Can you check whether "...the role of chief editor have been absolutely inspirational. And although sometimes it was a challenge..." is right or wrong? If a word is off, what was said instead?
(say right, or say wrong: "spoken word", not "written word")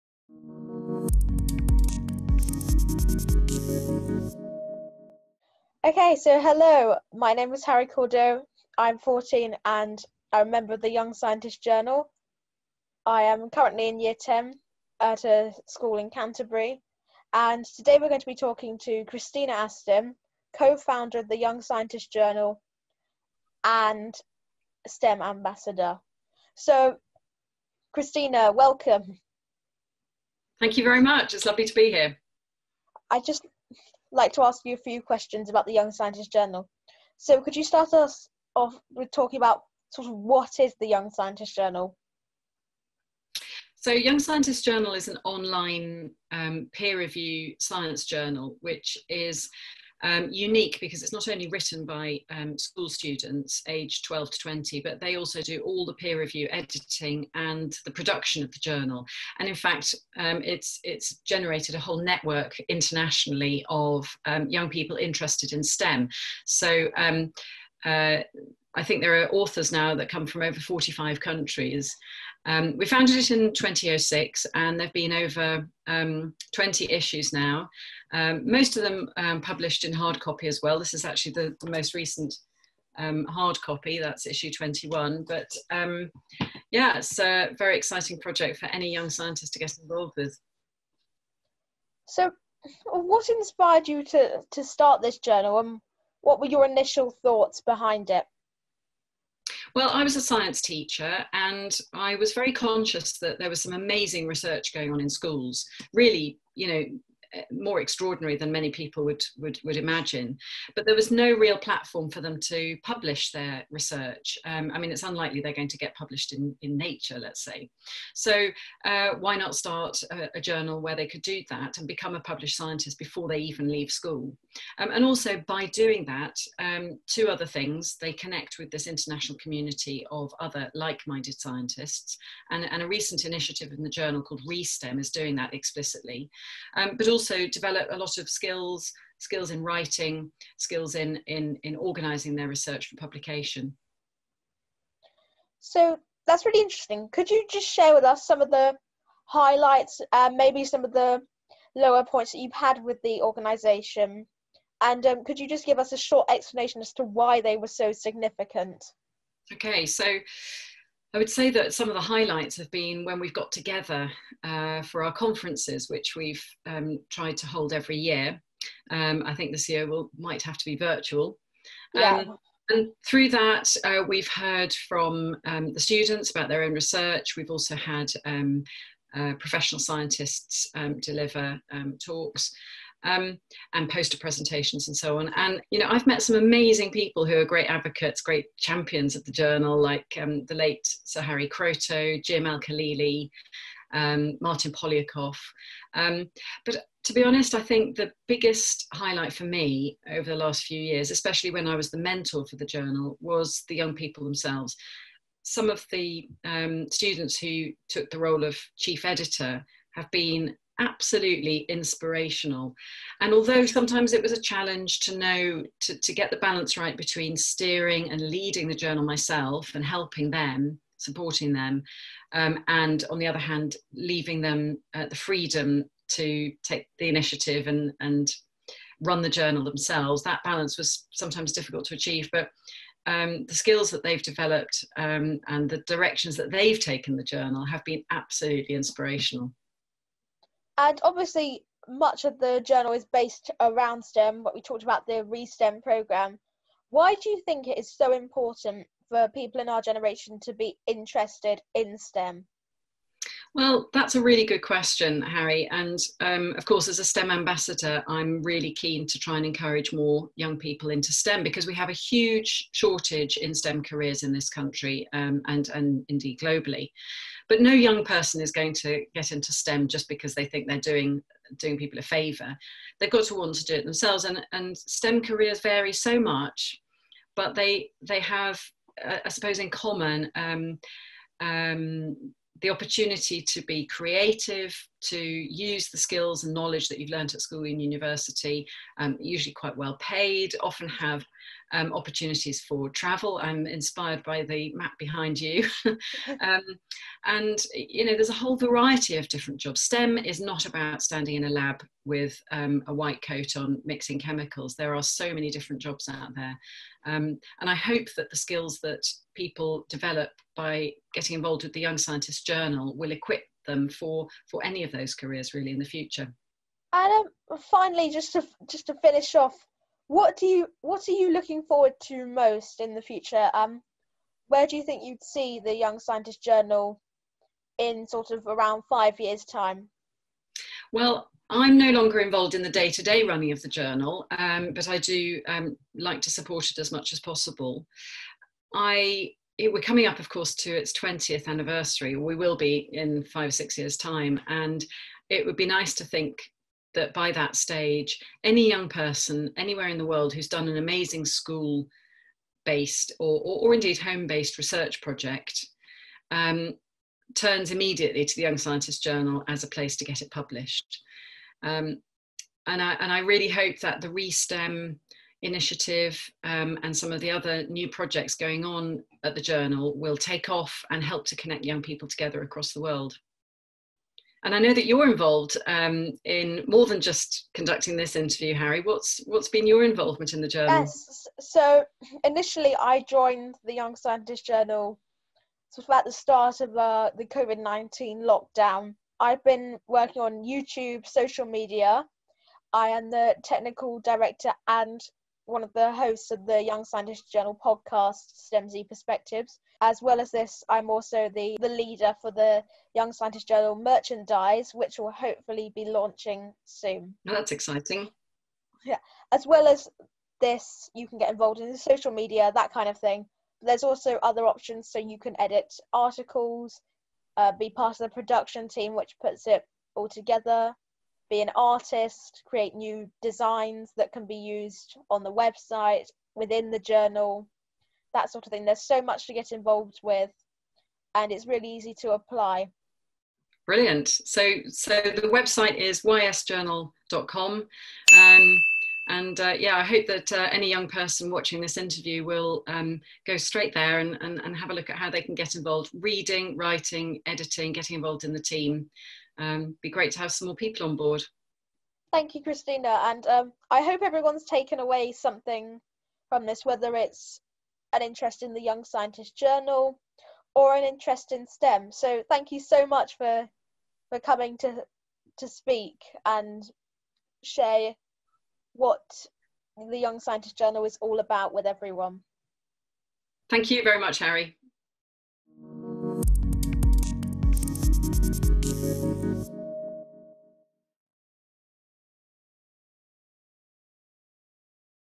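right.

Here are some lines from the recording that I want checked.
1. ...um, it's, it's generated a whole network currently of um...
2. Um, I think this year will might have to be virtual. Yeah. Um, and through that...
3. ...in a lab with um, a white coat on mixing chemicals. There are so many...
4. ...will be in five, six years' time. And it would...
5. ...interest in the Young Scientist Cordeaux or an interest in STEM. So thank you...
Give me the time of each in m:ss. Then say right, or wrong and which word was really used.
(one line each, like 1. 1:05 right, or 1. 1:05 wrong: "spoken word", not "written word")
1. 1:00 wrong: "internationally", not "currently"
2. 2:48 right
3. 5:01 right
4. 5:42 right
5. 7:38 wrong: "Journal", not "Cordeaux".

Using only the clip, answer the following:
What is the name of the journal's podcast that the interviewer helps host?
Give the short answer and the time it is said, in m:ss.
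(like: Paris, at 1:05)
STEMZ Perspectives, at 6:38.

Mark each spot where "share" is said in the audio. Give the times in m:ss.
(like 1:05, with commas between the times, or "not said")
2:27, 7:47.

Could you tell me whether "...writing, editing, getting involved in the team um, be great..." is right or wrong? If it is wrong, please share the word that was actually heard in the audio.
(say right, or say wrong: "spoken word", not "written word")
right.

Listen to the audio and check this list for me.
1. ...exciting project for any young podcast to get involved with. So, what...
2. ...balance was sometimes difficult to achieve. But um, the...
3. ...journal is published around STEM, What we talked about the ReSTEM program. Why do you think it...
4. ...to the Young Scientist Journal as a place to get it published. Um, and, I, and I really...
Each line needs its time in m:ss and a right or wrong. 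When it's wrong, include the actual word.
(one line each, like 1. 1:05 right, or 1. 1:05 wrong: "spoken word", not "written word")
1. 1:27 wrong: "scientist", not "podcast"
2. 3:50 right
3. 4:02 wrong: "based", not "published"
4. 5:58 right.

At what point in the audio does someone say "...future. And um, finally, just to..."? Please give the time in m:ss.
5:15.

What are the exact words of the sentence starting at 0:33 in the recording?
I just like to ask you a few questions about the Young Scientist Journal.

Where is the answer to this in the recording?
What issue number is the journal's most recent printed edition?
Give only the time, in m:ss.
1:24.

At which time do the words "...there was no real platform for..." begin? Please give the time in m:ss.
1:50.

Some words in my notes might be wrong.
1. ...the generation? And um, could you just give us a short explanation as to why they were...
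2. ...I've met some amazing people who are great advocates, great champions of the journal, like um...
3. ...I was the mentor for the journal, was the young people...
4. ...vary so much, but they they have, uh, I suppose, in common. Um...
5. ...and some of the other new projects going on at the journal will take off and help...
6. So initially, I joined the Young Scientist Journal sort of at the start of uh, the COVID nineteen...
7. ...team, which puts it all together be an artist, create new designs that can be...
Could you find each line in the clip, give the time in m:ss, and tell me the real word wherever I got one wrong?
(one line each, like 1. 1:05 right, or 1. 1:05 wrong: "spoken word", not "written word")
1. 2:33 wrong: "organization", not "generation"
2. 3:05 right
3. 3:21 right
4. 4:35 right
5. 6:06 right
6. 6:21 right
7. 6:58 right.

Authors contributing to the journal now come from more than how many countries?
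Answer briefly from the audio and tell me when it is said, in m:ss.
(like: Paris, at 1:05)
45, at 1:10.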